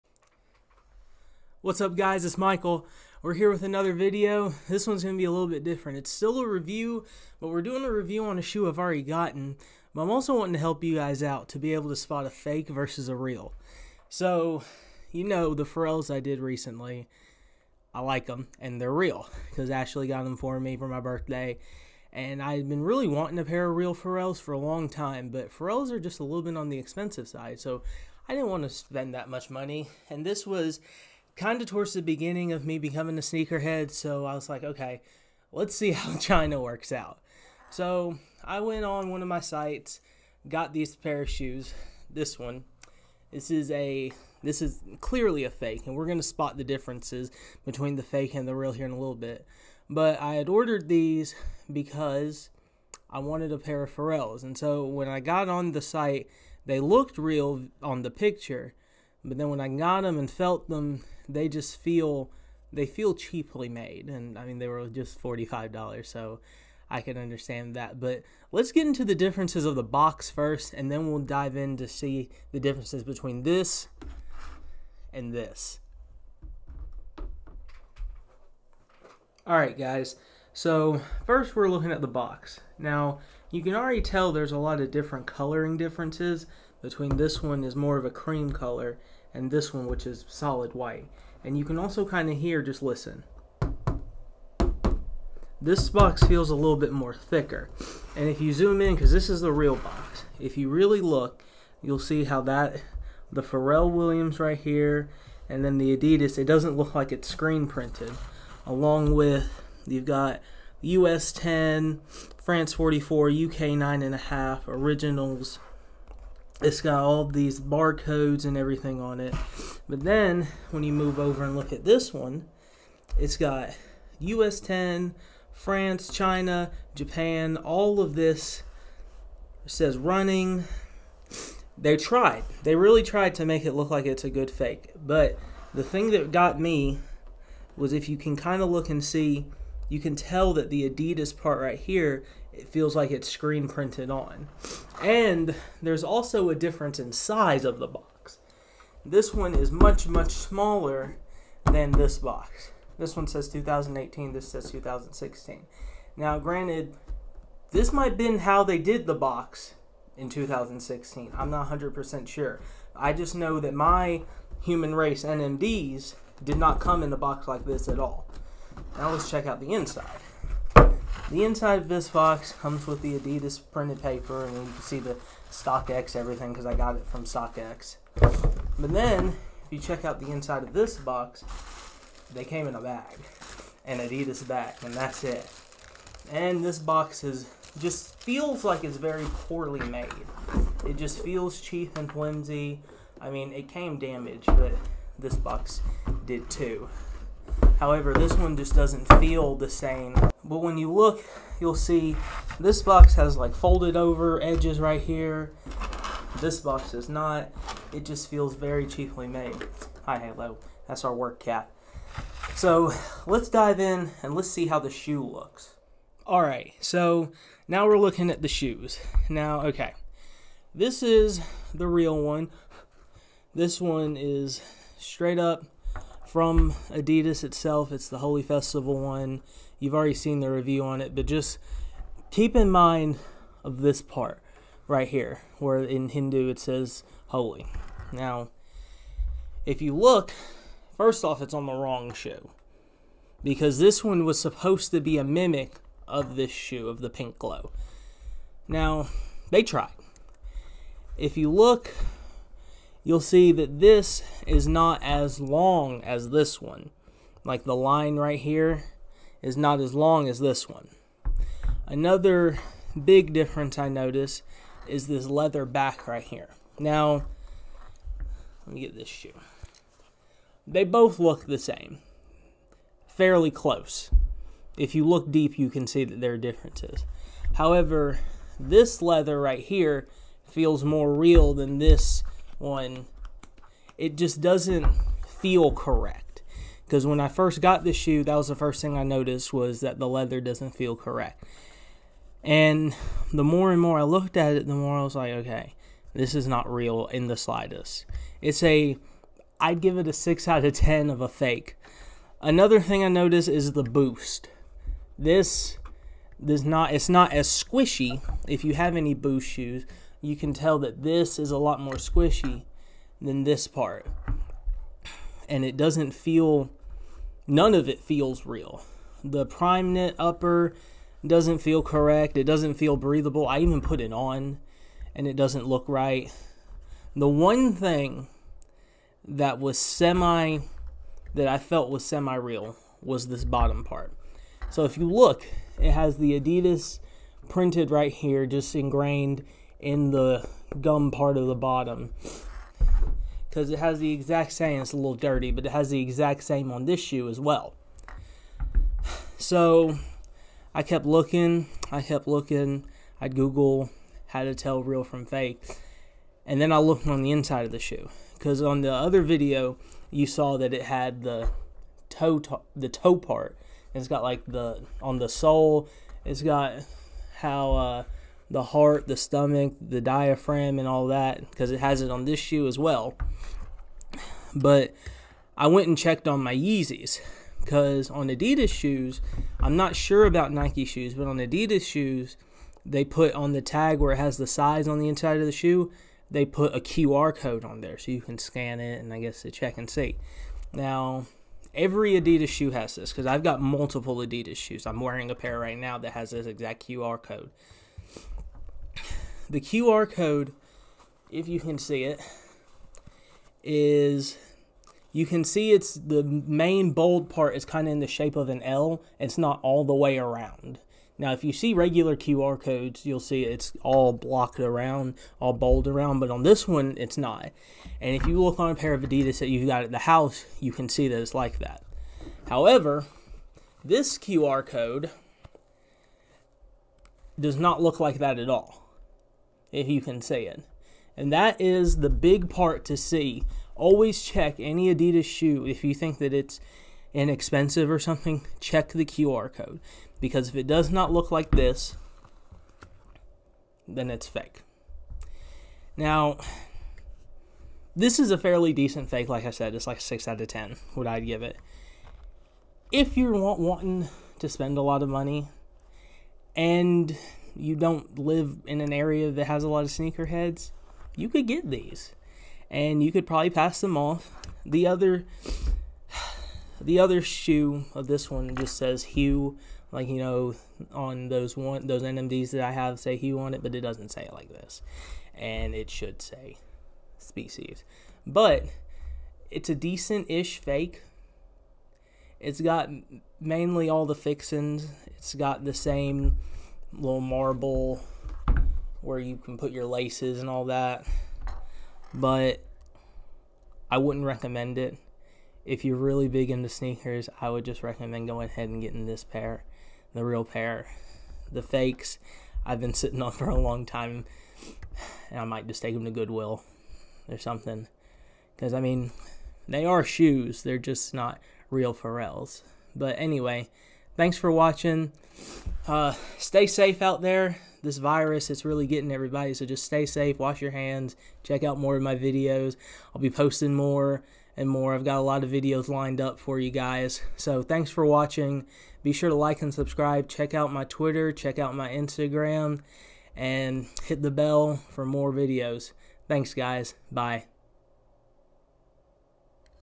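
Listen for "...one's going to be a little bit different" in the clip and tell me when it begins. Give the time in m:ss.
0:04.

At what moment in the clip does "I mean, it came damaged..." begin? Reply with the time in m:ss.
3:13.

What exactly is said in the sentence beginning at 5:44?
It's a little dirty, but it has the exact same on this shoe as well.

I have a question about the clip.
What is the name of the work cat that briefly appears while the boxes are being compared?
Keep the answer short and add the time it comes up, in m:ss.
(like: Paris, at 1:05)
Halo, at 3:30.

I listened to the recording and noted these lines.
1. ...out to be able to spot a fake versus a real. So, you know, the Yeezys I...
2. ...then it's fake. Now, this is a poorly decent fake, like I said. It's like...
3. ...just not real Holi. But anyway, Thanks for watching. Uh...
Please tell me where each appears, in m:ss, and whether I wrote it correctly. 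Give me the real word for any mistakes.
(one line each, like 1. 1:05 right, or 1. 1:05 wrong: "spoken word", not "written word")
1. 0:11 wrong: "Pharrells", not "Yeezys"
2. 7:23 wrong: "fairly", not "poorly"
3. 8:30 wrong: "Pharrells", not "Holi".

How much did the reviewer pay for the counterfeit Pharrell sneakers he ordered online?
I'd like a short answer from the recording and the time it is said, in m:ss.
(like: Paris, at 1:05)
$45, at 1:05.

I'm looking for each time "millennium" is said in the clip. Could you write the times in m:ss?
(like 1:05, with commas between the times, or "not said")
not said.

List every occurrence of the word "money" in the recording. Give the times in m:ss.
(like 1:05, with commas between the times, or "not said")
0:29, 7:35.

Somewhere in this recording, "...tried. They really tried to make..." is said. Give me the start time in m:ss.
2:11.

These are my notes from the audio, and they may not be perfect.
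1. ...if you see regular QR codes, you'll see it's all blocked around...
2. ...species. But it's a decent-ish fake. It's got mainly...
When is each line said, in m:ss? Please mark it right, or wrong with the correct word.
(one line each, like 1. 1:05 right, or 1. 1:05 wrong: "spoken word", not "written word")
1. 6:51 right
2. 7:57 right.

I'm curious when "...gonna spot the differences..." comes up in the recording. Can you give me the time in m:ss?
0:46.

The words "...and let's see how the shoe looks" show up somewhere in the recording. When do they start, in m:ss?
3:34.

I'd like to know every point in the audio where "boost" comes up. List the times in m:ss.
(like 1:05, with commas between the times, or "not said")
5:03, 5:09.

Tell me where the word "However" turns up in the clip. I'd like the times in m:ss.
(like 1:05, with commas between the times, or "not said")
3:17, 4:37, 7:02.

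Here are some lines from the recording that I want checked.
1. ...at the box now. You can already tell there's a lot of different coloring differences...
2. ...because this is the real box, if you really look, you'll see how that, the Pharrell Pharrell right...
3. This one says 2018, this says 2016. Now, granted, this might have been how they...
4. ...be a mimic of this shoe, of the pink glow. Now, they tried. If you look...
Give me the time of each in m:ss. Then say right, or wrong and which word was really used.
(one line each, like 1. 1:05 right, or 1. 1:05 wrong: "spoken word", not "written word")
1. 1:21 right
2. 1:38 wrong: "Williams", not "Pharrell"
3. 2:32 right
4. 4:05 right.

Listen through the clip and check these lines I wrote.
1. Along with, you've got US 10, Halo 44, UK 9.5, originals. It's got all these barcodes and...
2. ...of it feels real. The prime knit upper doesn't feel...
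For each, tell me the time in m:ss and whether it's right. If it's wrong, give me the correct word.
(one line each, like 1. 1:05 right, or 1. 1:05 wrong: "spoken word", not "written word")
1. 1:48 wrong: "France", not "Halo"
2. 5:17 right.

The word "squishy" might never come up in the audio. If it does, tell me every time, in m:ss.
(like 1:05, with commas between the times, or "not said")
5:07, 5:11.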